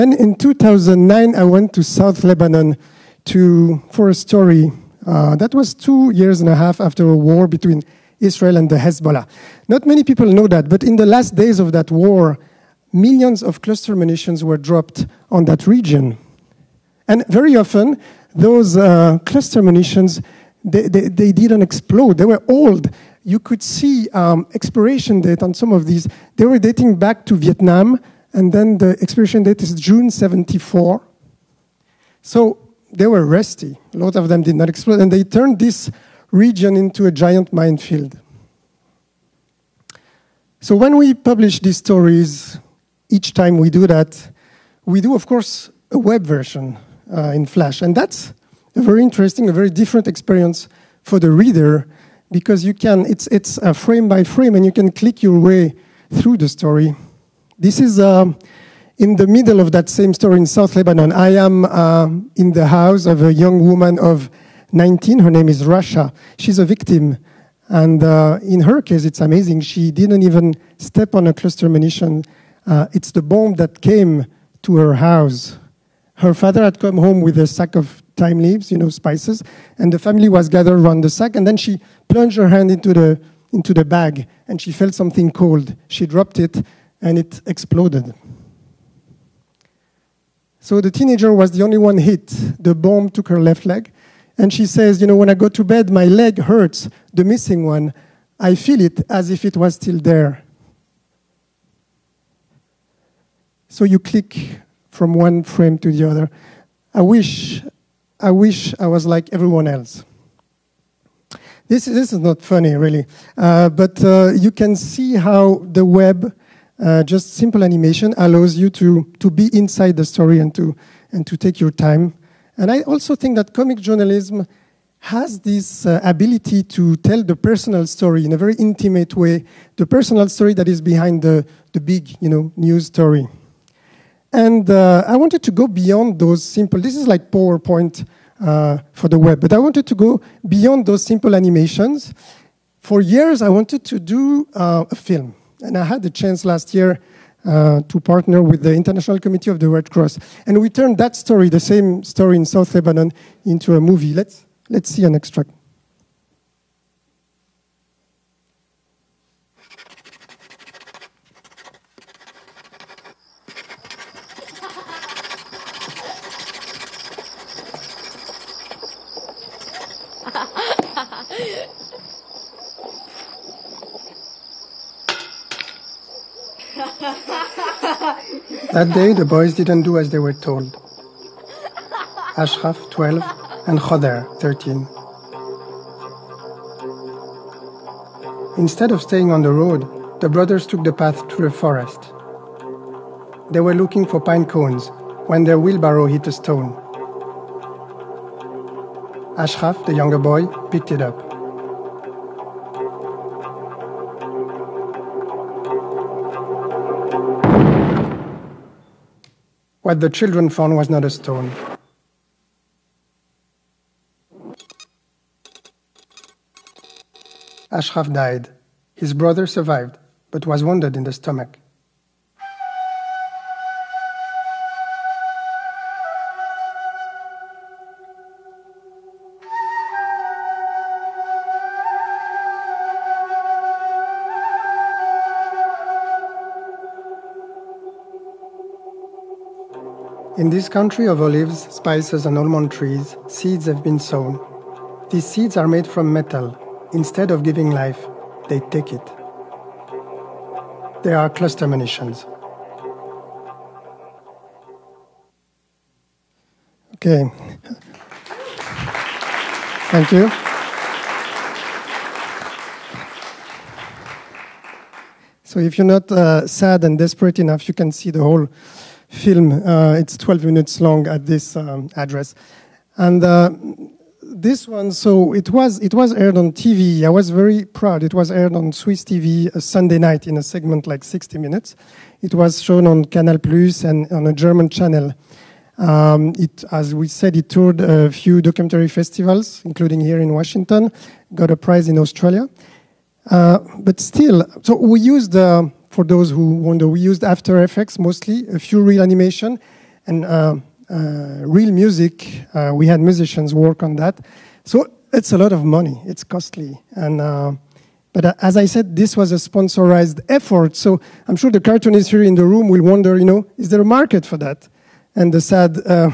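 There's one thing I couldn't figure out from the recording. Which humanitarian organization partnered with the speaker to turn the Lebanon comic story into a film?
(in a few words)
International Committee of the Red Cross.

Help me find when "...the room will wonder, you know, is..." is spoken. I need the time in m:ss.
5:12.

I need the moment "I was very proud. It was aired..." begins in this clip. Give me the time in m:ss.
4:37.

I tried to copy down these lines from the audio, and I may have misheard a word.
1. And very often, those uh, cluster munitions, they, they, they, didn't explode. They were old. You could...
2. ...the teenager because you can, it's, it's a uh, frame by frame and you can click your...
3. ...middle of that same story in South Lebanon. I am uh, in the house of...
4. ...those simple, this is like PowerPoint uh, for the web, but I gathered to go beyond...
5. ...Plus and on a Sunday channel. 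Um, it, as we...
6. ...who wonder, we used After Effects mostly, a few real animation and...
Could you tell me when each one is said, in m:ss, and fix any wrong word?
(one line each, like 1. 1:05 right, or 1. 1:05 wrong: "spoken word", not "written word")
1. 0:17 right
2. 0:51 wrong: "reader", not "teenager"
3. 0:59 right
4. 2:16 wrong: "wanted", not "gathered"
5. 4:43 wrong: "German", not "Sunday"
6. 4:56 right.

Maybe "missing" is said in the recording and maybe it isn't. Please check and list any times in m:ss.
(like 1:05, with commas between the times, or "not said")
1:37.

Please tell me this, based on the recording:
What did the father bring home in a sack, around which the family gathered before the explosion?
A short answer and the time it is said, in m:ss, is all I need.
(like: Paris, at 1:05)
Thyme leaves, at 1:18.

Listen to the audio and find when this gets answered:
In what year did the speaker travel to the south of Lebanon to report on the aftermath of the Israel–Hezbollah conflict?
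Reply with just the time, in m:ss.
0:00.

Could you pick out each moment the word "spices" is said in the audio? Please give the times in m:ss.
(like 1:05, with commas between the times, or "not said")
1:18, 4:01.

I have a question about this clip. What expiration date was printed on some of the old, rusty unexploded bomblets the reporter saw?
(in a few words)
June 74.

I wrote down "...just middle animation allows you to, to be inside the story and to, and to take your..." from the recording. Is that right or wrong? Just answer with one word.
wrong.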